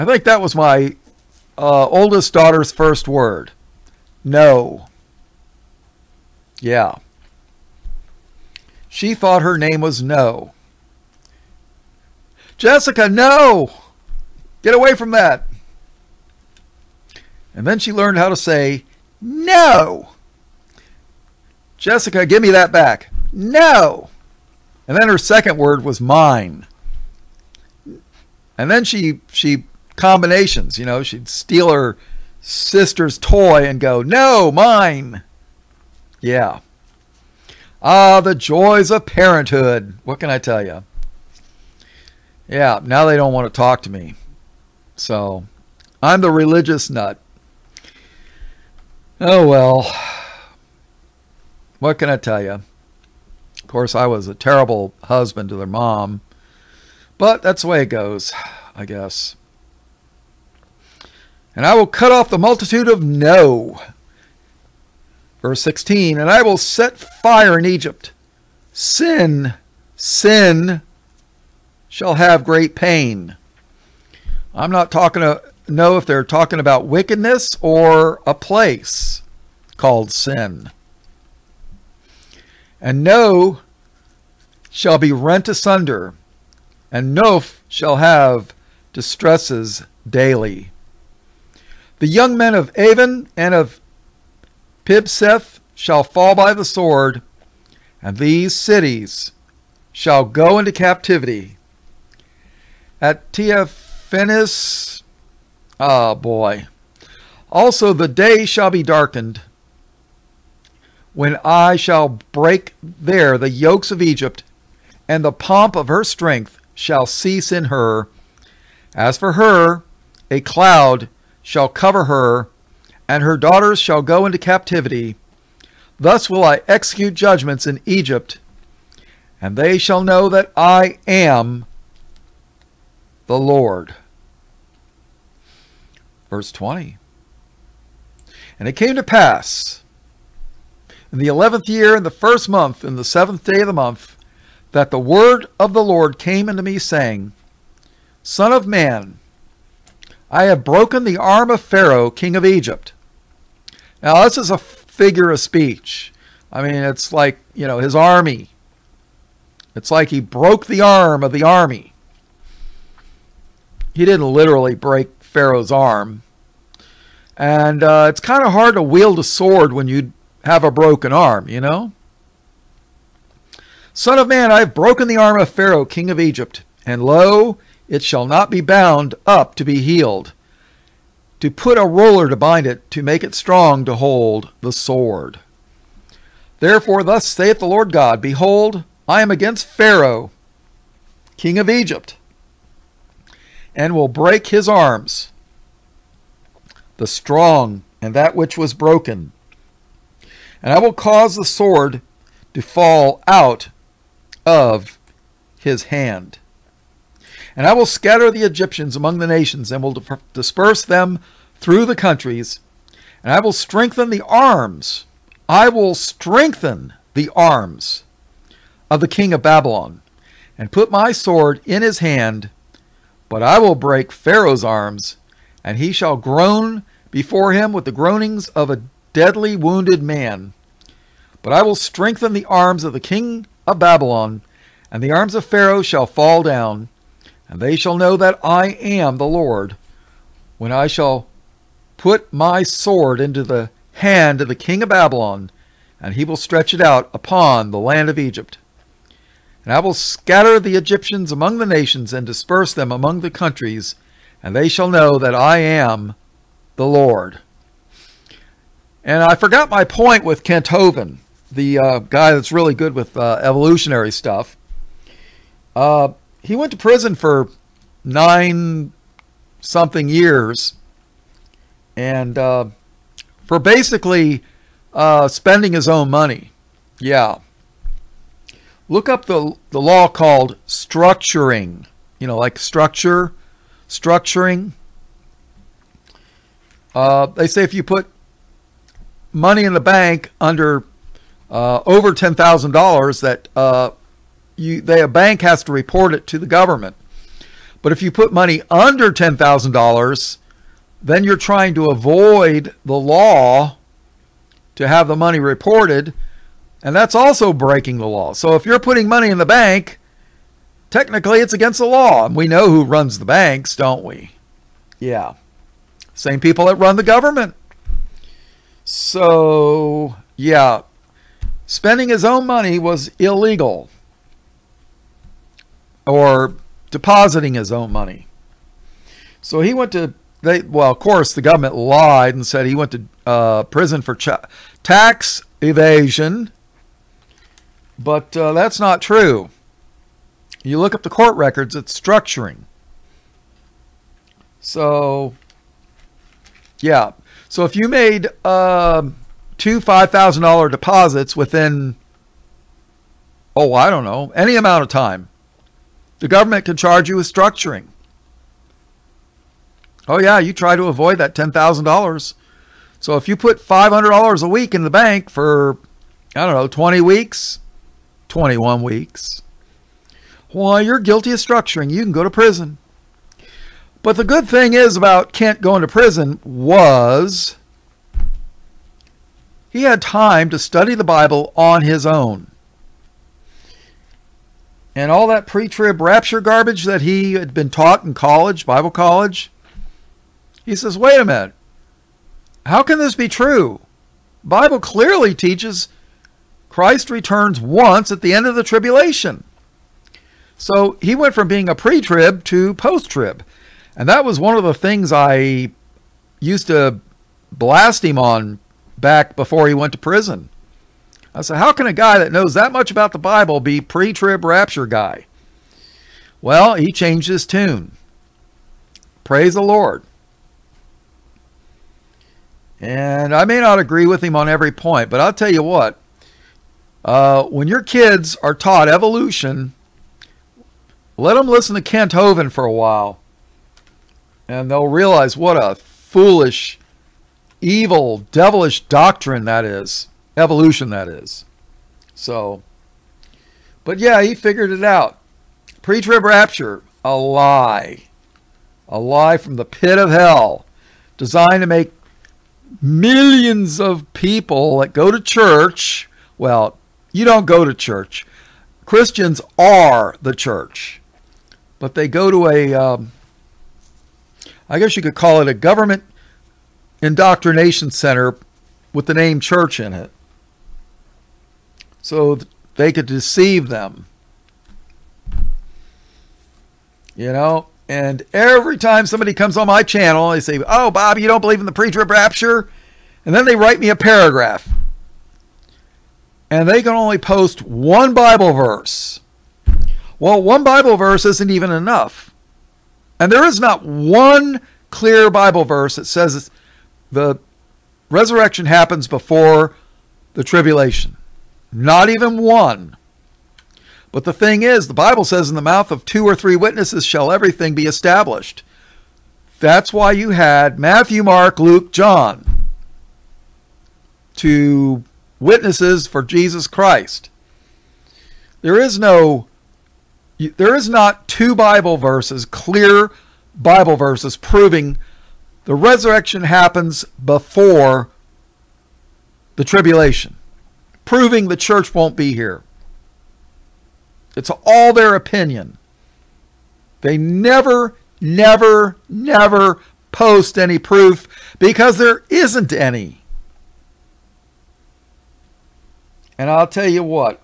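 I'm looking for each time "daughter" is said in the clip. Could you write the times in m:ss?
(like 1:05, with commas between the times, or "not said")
0:02, 2:03.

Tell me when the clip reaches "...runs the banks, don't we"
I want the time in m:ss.
5:12.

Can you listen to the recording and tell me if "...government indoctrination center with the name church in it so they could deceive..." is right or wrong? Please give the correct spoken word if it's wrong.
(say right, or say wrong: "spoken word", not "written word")
right.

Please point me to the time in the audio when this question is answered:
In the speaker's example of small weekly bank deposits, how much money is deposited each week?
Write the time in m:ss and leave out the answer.
6:03.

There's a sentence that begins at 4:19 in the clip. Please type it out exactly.
And I forgot my point with Kent Hovind, the uh, guy that's really good with uh, evolutionary stuff.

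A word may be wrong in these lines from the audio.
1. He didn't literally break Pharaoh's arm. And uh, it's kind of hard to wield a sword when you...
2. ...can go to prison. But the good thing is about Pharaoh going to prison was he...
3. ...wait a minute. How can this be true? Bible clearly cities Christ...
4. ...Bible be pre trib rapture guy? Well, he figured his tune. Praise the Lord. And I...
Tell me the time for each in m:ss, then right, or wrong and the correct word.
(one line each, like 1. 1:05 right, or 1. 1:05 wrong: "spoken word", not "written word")
1. 2:43 right
2. 6:12 wrong: "Kent", not "Pharaoh"
3. 6:30 wrong: "teaches", not "cities"
4. 6:53 wrong: "changed", not "figured".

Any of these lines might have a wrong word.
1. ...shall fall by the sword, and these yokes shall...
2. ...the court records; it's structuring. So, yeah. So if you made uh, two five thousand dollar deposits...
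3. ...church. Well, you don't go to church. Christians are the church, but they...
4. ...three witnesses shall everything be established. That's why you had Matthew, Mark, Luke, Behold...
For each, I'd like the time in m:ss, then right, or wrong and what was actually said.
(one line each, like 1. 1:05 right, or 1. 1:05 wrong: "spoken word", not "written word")
1. 1:35 wrong: "cities", not "yokes"
2. 5:41 right
3. 7:35 right
4. 8:26 wrong: "John", not "Behold".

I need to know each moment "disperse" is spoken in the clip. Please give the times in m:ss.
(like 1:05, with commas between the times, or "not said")
3:30, 4:12.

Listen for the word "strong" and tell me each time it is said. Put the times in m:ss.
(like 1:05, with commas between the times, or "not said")
3:03, 3:17.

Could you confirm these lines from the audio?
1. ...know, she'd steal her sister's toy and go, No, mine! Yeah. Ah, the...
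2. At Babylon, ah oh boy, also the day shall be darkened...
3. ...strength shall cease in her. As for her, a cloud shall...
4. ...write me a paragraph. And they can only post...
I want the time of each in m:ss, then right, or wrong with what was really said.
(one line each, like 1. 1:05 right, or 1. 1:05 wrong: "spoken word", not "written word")
1. 0:30 right
2. 1:42 wrong: "Tehaphnehes", not "Babylon"
3. 1:56 right
4. 8:03 right.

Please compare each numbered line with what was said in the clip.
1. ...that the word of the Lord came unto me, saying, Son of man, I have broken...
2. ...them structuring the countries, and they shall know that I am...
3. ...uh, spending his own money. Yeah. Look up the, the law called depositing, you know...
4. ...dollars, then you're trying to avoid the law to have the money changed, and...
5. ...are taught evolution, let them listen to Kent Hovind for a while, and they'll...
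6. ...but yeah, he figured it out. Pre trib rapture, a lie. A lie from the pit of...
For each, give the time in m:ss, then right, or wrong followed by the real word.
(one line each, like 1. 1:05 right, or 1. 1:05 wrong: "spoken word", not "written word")
1. 2:24 right
2. 4:12 wrong: "among", not "structuring"
3. 4:34 wrong: "structuring", not "depositing"
4. 4:59 wrong: "reported", not "changed"
5. 7:08 right
6. 7:23 right.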